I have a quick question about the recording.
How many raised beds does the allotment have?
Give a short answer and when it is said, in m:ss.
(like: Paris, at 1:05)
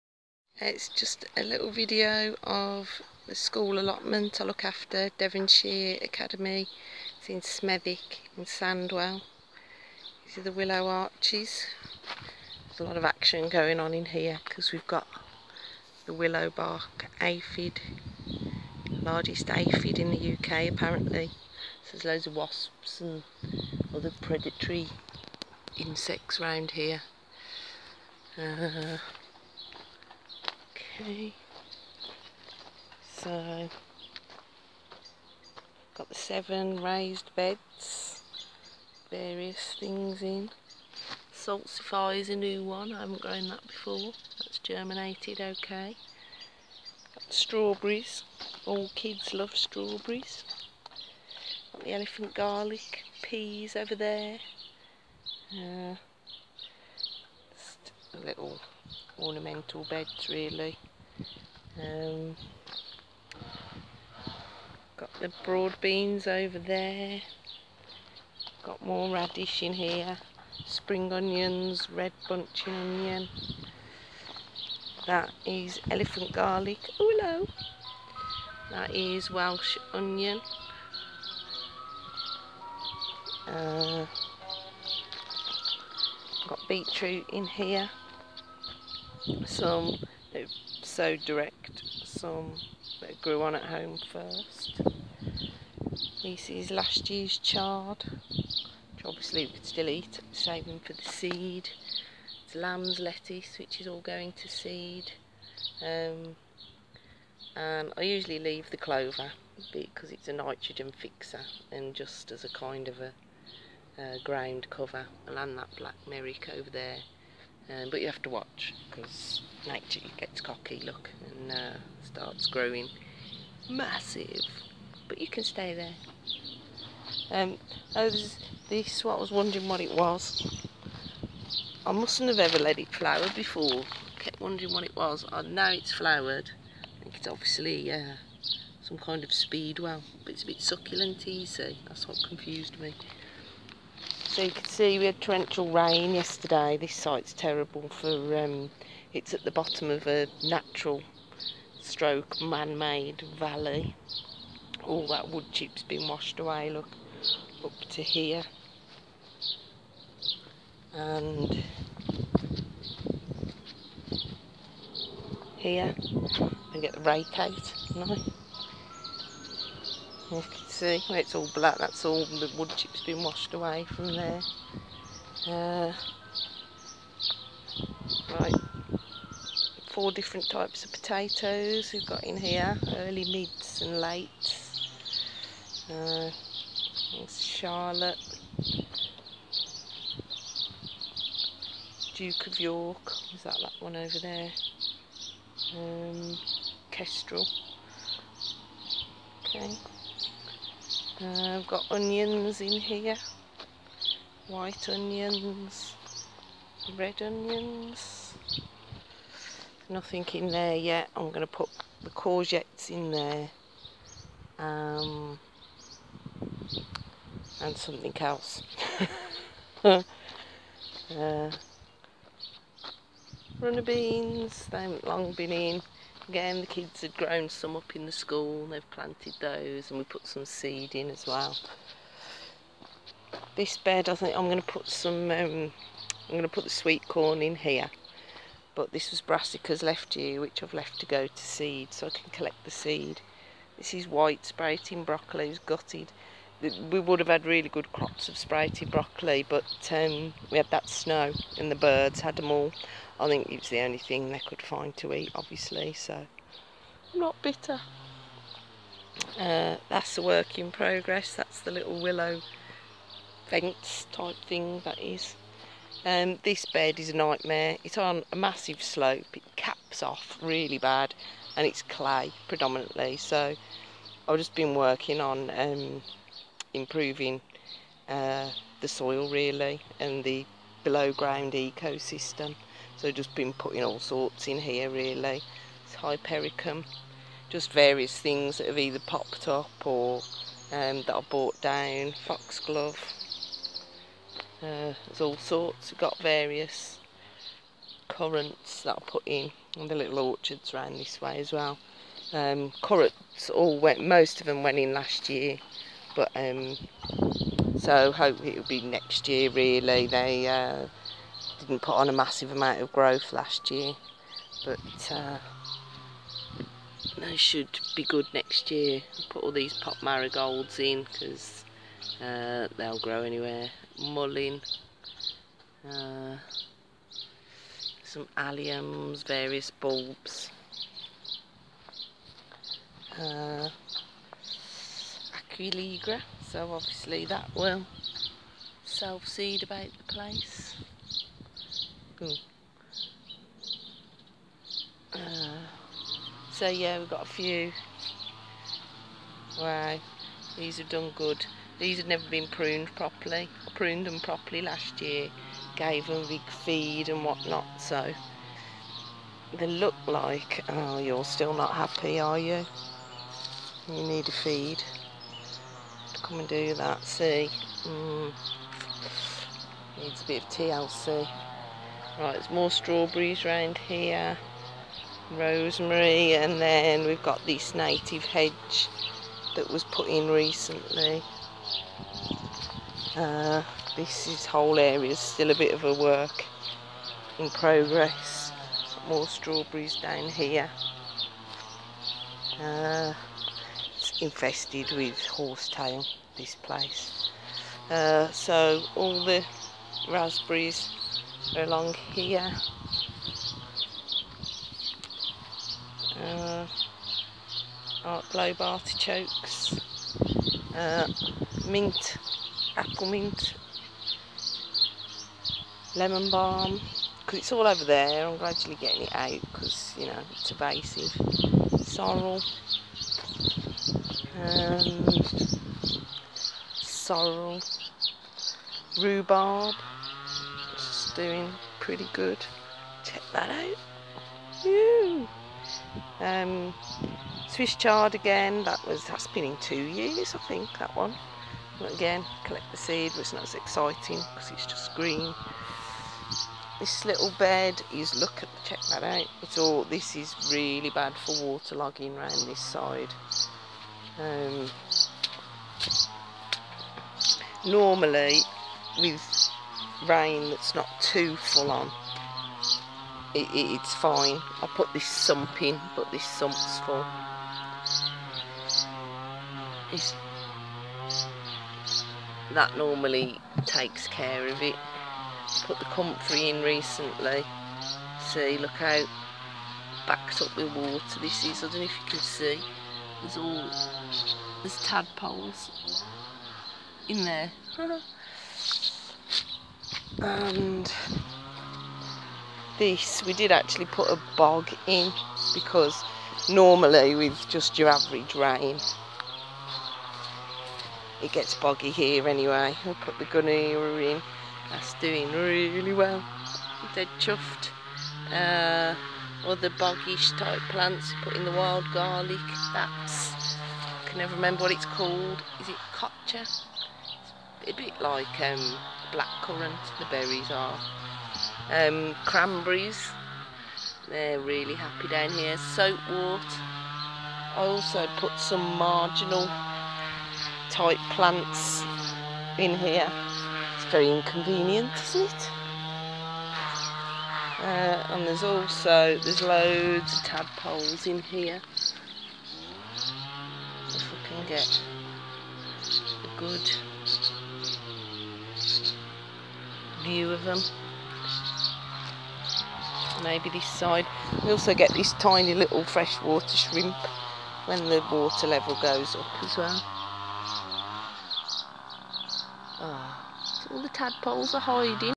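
7, at 0:36.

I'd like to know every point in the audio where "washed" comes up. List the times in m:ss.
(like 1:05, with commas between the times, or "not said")
2:36, 2:53.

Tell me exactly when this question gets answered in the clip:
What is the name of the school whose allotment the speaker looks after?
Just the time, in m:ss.
0:05.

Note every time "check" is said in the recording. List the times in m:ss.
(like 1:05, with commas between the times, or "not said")
7:13, 7:28.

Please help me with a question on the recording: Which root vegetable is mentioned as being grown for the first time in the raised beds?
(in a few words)
Salsify.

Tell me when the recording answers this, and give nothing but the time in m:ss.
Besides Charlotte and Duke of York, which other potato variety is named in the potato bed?
3:16.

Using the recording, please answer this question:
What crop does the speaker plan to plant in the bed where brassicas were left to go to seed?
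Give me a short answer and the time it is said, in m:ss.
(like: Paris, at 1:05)
Sweet corn, at 3:56.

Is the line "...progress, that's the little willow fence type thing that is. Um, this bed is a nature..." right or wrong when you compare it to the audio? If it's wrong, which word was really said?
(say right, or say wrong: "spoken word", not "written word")
wrong: "nightmare", not "nature".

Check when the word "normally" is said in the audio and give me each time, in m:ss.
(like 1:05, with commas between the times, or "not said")
7:37, 7:52, 8:16.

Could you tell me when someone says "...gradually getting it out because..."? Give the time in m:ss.
6:58.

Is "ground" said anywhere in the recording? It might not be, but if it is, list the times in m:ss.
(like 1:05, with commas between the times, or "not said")
1:54, 4:41.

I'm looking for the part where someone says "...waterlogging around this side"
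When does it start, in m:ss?
7:31.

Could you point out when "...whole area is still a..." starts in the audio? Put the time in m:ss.
6:24.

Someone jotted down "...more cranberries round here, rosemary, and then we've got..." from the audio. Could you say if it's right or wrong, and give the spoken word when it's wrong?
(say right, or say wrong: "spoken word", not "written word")
wrong: "strawberries", not "cranberries".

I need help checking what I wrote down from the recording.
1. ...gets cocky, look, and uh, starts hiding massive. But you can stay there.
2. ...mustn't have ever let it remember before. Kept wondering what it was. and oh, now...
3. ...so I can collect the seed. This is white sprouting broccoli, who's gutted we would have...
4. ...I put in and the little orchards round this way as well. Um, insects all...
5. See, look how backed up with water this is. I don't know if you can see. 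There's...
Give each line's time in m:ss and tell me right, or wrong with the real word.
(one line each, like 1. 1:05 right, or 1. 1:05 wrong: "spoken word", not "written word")
1. 2:00 wrong: "growing", not "hiding"
2. 2:11 wrong: "flower", not "remember"
3. 4:01 right
4. 4:58 wrong: "currants", not "insects"
5. 7:58 right.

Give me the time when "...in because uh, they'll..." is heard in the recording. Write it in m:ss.
5:20.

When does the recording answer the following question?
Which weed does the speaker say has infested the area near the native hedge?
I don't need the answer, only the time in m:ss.
6:35.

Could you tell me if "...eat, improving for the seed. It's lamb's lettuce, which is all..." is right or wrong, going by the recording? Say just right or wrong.
wrong.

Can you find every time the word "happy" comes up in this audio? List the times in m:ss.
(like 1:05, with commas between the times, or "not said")
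6:01, 8:44.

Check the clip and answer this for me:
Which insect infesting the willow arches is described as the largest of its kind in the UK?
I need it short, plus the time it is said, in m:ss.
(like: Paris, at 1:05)
Willow bark aphid, at 0:16.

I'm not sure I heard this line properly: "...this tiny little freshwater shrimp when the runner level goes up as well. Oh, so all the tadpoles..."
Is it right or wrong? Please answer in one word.
wrong.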